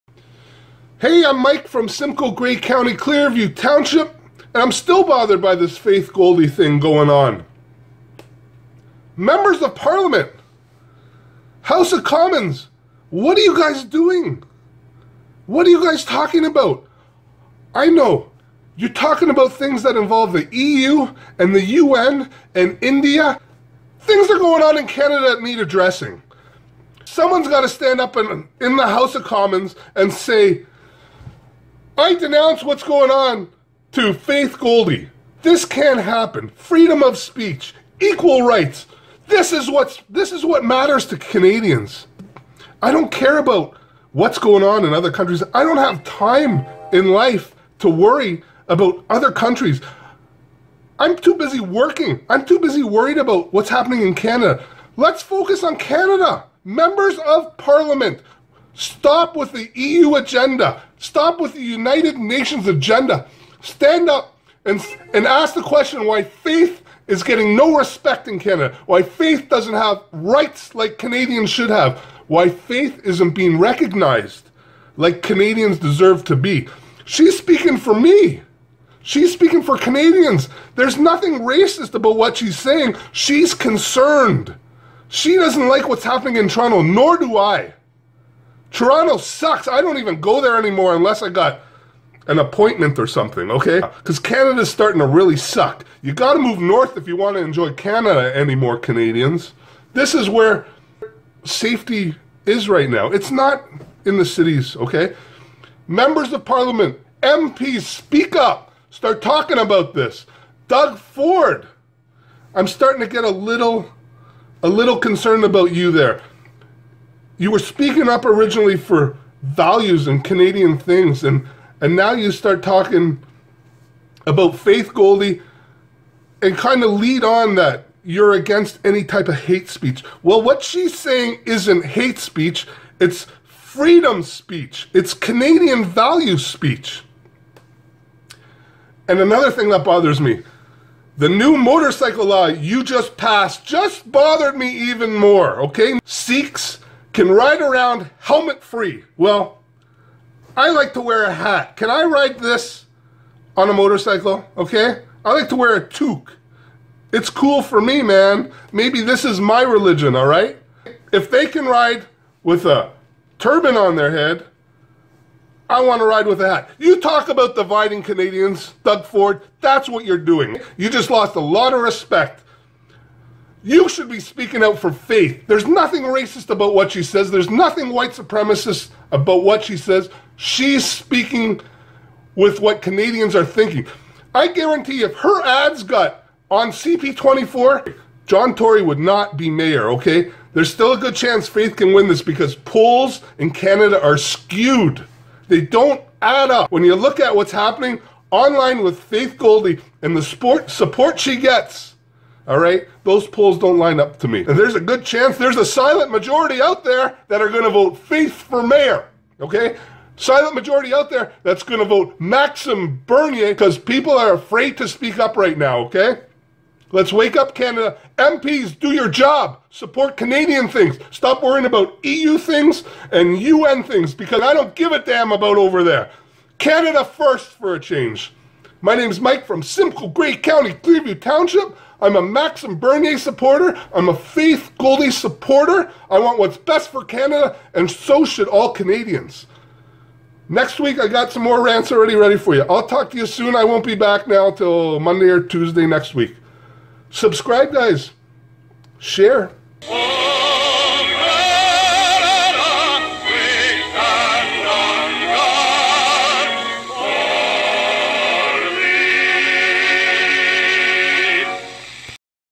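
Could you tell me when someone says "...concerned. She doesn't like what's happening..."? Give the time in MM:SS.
01:23.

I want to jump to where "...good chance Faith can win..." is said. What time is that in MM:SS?
03:10.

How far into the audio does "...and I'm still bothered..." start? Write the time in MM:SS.
00:04.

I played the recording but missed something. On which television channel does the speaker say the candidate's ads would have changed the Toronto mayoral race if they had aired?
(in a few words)
CP24.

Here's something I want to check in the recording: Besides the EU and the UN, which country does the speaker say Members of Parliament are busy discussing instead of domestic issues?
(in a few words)
India.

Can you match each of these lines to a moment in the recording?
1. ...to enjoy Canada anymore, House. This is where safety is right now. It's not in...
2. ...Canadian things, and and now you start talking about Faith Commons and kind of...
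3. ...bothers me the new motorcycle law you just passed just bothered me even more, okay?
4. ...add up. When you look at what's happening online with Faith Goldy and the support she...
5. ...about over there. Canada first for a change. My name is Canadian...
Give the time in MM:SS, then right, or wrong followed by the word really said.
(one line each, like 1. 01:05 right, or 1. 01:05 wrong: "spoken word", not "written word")
1. 01:37 wrong: "Canadians", not "House"
2. 02:00 wrong: "Goldy", not "Commons"
3. 02:19 right
4. 03:16 right
5. 03:45 wrong: "Mike", not "Canadian".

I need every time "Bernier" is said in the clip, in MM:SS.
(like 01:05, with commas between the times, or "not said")
03:33, 03:52.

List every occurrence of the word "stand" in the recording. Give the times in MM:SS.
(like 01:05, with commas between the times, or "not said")
00:27, 01:03.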